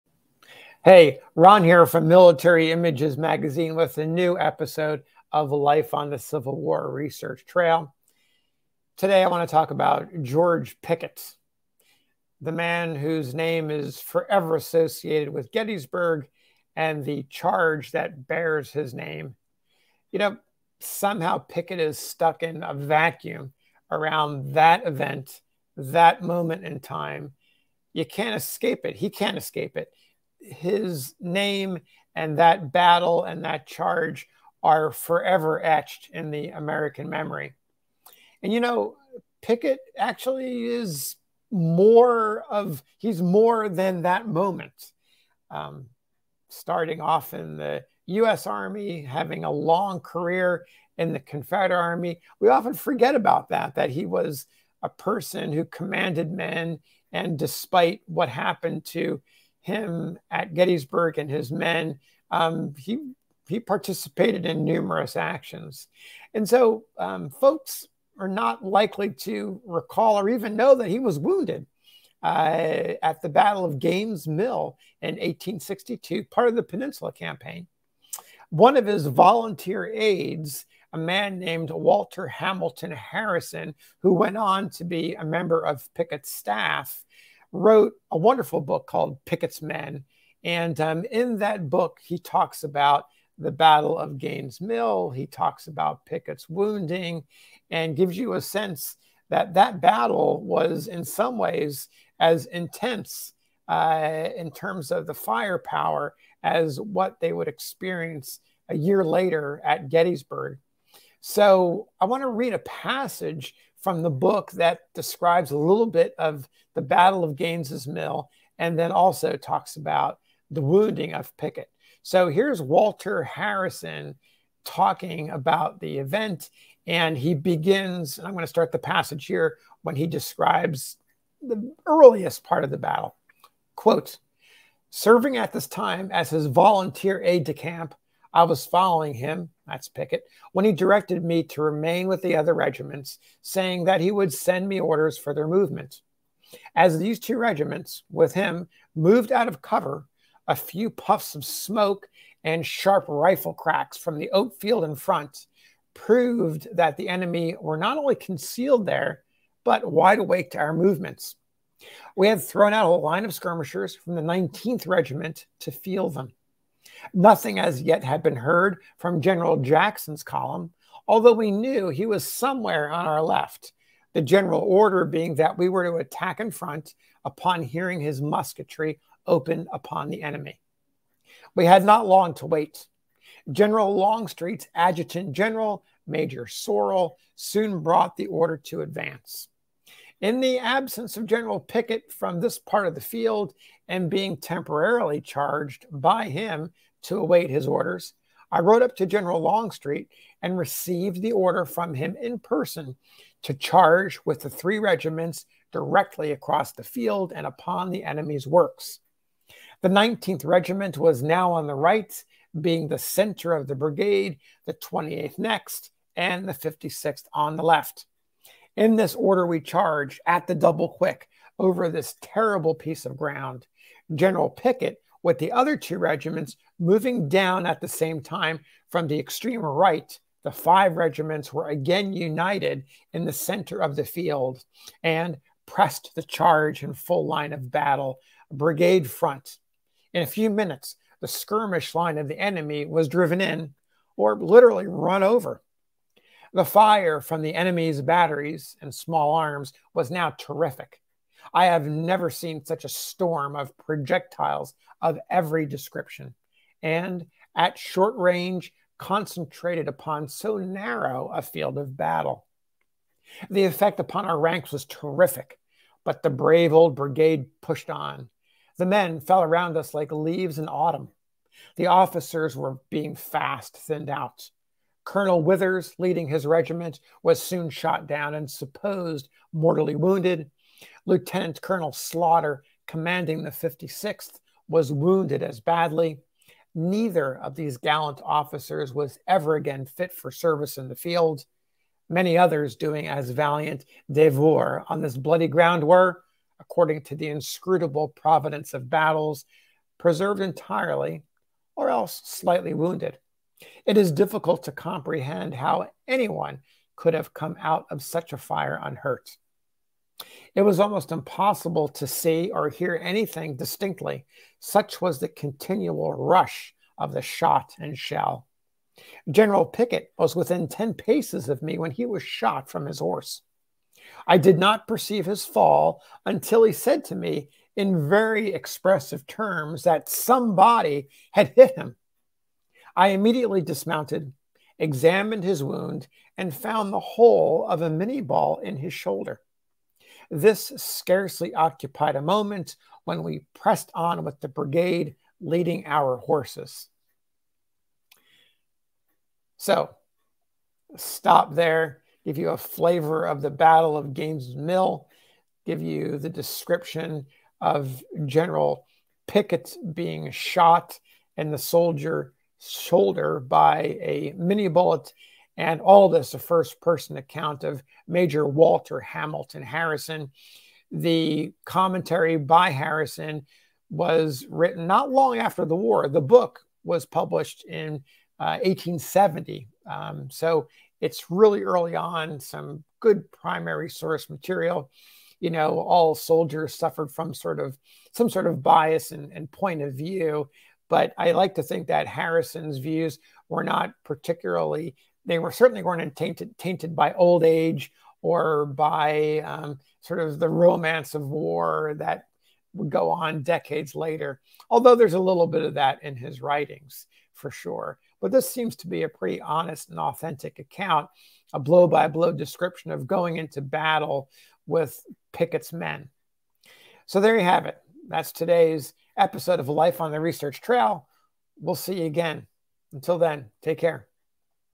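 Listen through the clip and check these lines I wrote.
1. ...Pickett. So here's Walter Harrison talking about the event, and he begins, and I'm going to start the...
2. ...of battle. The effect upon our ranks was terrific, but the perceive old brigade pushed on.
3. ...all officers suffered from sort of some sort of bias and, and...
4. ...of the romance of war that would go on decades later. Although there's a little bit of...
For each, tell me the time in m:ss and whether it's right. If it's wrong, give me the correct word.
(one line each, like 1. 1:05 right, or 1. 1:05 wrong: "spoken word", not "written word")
1. 2:01 right
2. 4:21 wrong: "brave", not "perceive"
3. 6:25 wrong: "soldiers", not "officers"
4. 6:40 right.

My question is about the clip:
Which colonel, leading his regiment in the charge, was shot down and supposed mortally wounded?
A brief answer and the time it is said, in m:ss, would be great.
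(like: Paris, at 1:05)
Colonel Withers, at 4:35.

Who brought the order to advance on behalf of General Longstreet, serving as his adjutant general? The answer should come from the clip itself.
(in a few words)
Major Sorrell.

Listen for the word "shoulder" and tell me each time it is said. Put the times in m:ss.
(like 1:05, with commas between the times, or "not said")
5:38, 6:02.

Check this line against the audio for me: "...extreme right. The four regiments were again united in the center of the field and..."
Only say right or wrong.
wrong.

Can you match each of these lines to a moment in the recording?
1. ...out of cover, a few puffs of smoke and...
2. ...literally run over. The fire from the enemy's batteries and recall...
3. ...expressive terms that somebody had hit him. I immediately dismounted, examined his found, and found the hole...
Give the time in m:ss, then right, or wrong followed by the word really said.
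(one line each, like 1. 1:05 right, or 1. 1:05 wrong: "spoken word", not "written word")
1. 2:29 right
2. 4:04 wrong: "small", not "recall"
3. 5:28 wrong: "wound", not "found".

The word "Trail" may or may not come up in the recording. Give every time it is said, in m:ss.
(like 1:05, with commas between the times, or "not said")
0:07, 7:00.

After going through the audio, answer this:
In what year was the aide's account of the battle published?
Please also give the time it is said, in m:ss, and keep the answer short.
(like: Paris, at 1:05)
1870, at 6:18.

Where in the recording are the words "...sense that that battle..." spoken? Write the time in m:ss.
1:38.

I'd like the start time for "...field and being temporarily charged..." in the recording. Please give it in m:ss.
3:13.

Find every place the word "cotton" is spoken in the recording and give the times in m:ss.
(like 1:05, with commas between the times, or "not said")
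not said.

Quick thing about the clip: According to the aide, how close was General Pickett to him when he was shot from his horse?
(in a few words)
10 paces.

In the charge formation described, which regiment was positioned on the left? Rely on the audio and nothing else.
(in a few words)
56th.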